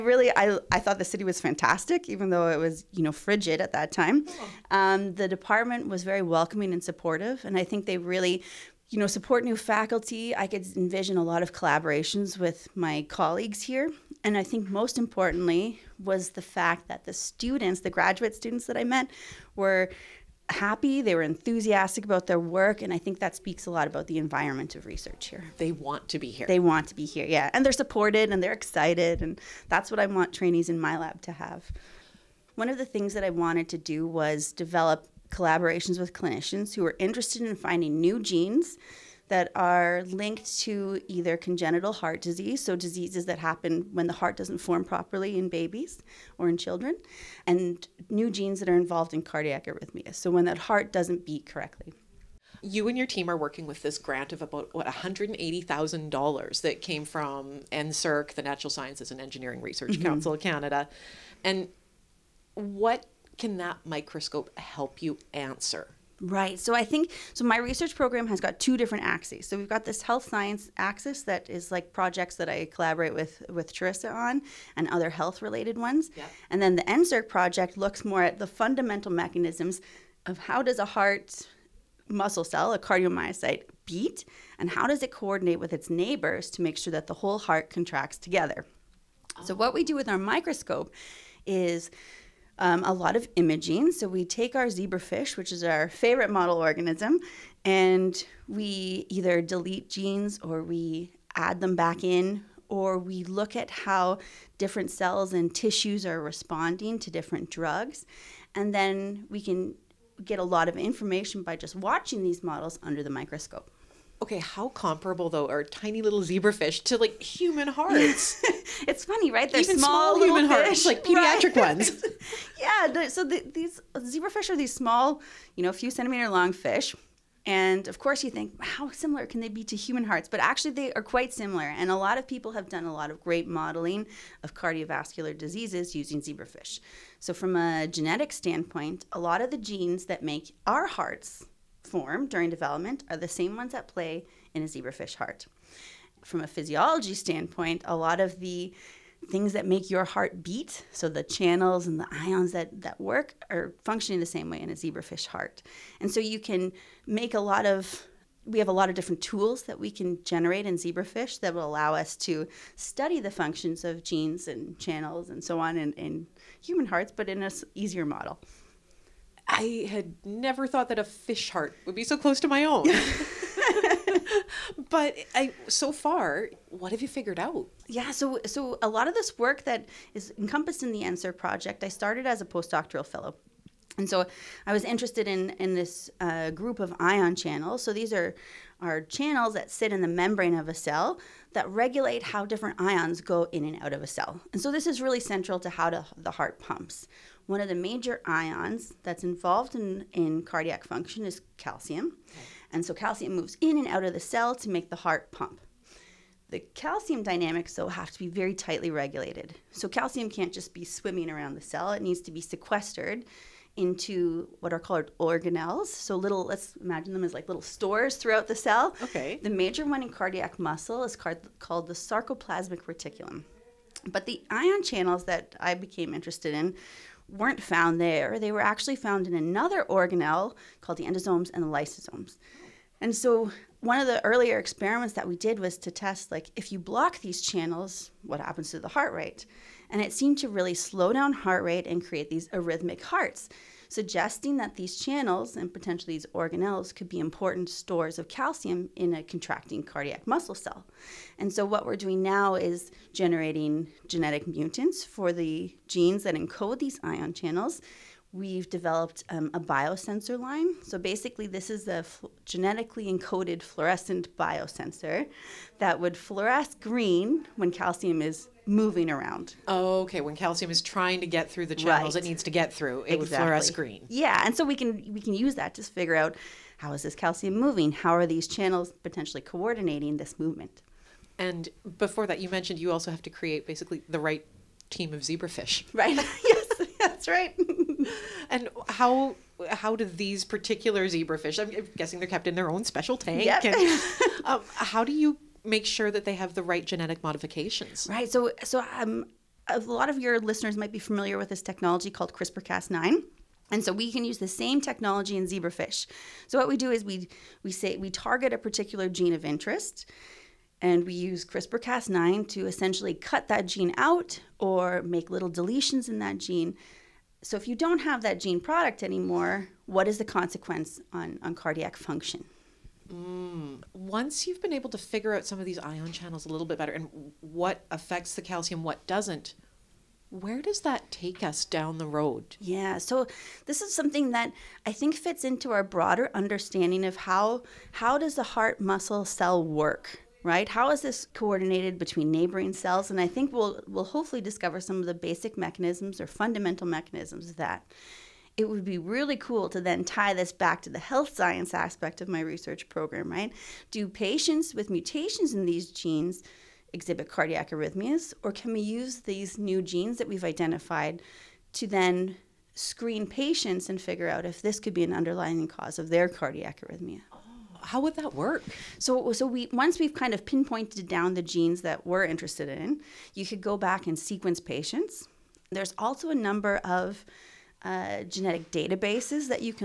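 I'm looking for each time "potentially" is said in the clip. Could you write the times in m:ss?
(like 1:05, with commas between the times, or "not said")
4:05, 4:39.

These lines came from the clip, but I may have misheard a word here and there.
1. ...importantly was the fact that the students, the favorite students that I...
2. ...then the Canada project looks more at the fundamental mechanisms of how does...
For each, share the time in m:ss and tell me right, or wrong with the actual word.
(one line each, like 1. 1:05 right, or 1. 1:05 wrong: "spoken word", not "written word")
1. 0:14 wrong: "graduate", not "favorite"
2. 1:16 wrong: "NSERC", not "Canada".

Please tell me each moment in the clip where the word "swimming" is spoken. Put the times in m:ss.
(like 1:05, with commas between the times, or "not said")
3:30.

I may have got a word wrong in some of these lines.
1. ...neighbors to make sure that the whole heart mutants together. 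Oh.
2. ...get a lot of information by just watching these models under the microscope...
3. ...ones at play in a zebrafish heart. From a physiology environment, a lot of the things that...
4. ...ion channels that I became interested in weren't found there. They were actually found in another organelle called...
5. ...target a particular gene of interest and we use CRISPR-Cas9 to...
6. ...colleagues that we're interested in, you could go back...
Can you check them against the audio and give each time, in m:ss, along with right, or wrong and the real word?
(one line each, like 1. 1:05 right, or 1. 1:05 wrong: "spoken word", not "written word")
1. 1:25 wrong: "contracts", not "mutants"
2. 1:50 right
3. 2:23 wrong: "standpoint", not "environment"
4. 3:44 right
5. 5:08 right
6. 6:11 wrong: "genes", not "colleagues".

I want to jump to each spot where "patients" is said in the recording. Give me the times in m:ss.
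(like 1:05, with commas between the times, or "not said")
5:54, 6:03, 6:14.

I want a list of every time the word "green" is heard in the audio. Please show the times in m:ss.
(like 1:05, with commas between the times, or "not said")
4:26, 4:33.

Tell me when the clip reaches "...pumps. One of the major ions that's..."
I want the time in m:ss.
3:16.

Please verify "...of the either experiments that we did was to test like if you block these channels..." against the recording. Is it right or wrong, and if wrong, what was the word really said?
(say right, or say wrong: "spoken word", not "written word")
wrong: "earlier", not "either".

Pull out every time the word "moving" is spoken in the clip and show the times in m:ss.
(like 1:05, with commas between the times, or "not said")
4:28, 4:37.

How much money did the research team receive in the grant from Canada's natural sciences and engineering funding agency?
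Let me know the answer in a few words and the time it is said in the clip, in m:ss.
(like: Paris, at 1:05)
$180,000, at 0:54.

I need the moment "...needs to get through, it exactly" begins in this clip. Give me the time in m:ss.
4:32.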